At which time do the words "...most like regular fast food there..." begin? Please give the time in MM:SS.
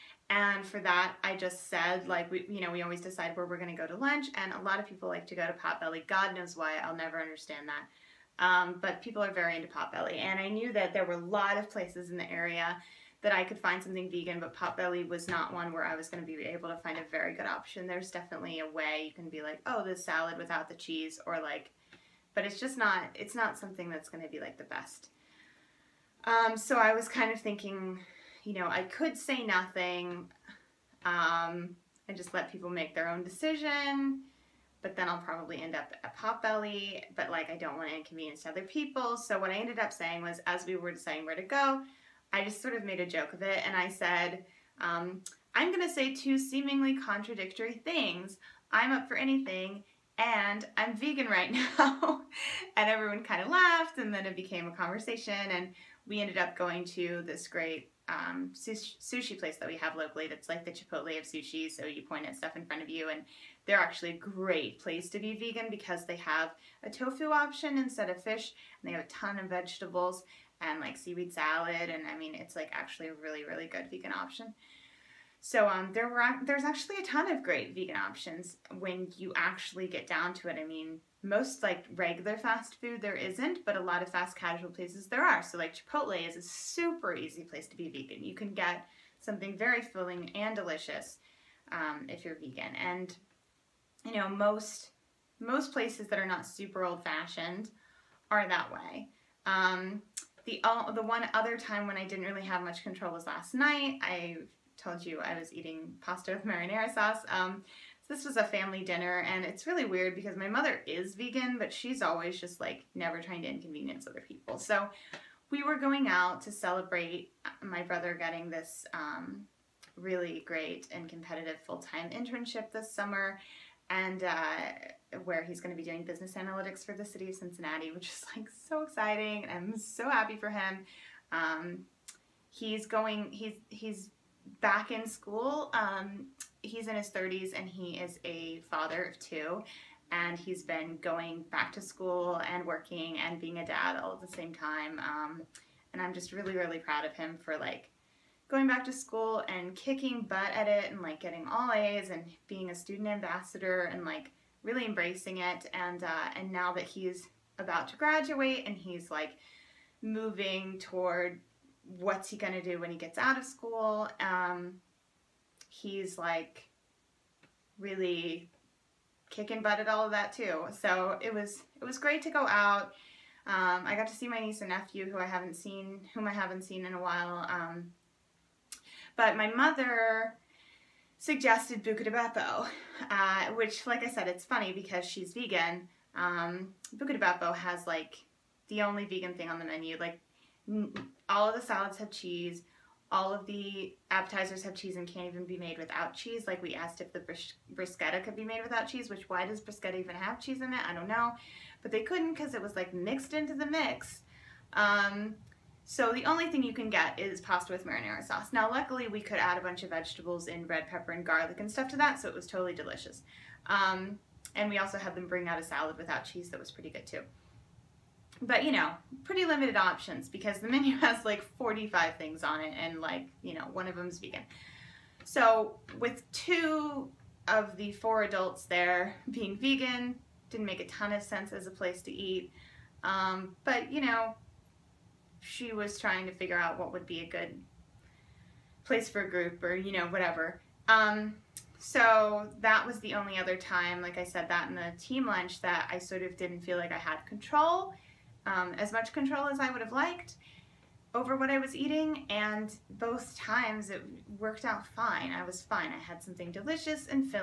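01:21.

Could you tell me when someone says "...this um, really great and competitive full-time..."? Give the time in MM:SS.
01:58.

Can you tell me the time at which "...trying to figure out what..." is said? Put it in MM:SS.
03:55.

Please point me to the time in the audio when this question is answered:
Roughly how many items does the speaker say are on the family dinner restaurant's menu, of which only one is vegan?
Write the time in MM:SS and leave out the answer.
03:41.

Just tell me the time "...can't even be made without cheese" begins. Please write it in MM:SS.
03:15.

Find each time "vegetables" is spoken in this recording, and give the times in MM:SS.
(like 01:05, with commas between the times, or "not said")
01:09, 03:29.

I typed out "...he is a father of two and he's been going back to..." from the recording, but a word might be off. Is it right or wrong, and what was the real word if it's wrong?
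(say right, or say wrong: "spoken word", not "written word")
right.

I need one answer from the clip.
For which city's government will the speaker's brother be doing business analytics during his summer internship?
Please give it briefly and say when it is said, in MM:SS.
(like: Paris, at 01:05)
Cincinnati, at 02:07.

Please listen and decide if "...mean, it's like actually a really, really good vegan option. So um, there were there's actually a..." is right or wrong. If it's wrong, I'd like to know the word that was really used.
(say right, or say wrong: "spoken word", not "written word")
right.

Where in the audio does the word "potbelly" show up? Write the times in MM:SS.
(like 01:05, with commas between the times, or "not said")
00:05, 00:09, 00:14, 00:36.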